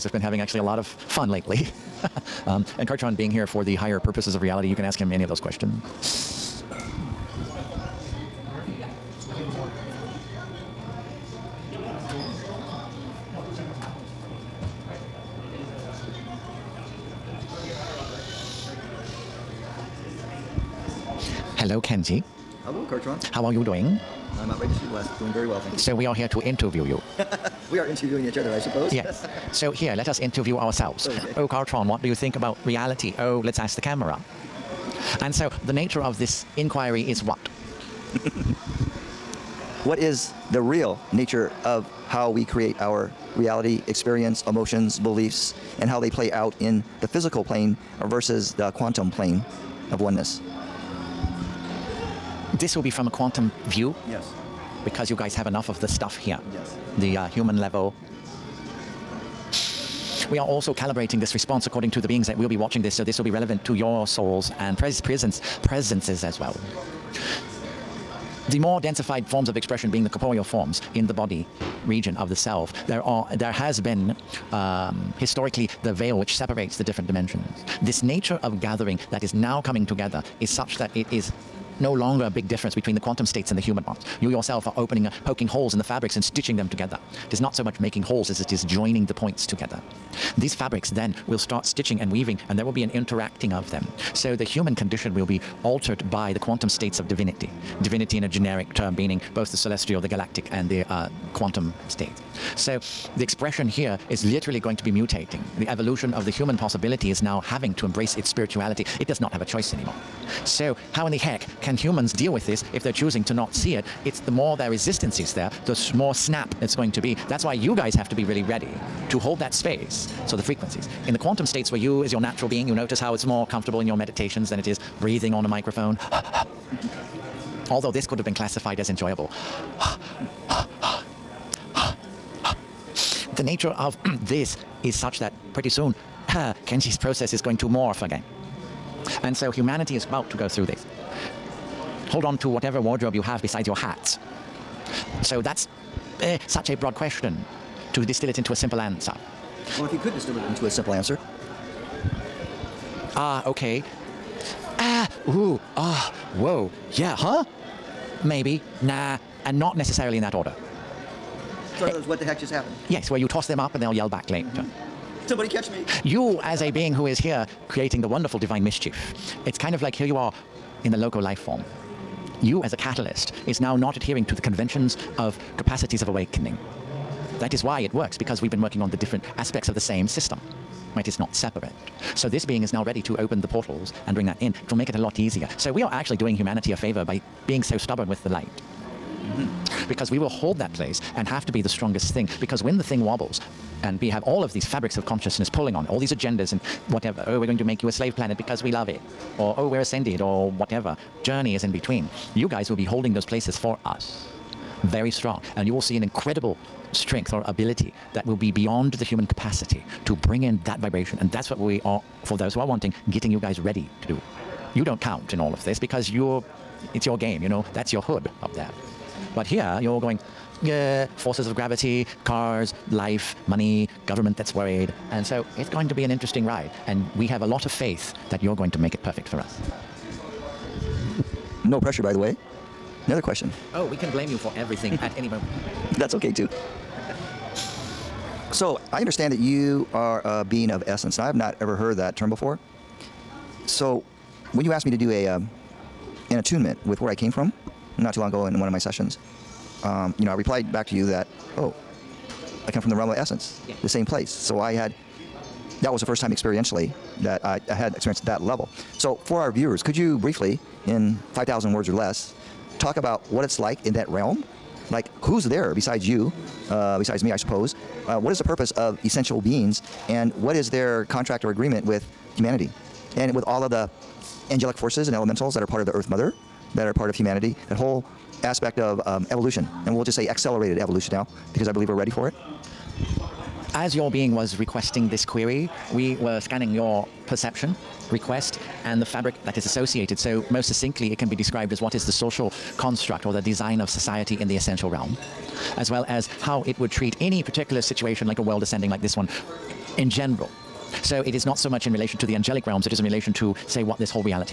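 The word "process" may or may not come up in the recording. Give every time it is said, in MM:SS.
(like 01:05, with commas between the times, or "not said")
02:16.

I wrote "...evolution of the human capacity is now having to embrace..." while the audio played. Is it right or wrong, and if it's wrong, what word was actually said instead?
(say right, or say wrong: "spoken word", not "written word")
wrong: "possibility", not "capacity".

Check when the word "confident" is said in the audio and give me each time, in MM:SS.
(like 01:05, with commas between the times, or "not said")
not said.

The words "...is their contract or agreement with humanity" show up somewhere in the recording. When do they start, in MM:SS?
04:30.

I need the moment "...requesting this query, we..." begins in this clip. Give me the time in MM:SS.
04:44.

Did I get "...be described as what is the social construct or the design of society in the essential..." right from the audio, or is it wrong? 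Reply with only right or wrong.
right.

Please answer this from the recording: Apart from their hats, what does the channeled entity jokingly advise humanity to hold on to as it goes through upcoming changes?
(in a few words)
wardrobe.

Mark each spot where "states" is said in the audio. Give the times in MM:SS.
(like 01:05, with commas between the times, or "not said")
01:23, 01:36, 01:41, 02:01.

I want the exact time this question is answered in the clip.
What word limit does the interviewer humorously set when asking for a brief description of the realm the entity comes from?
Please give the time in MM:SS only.
04:21.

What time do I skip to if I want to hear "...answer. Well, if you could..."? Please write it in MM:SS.
02:28.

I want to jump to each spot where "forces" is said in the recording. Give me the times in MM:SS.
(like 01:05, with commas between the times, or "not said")
03:41, 04:34.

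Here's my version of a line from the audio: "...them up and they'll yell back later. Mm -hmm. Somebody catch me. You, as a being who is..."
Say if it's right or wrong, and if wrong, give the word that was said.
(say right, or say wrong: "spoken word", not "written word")
right.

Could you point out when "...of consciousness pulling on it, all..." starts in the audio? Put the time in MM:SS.
03:14.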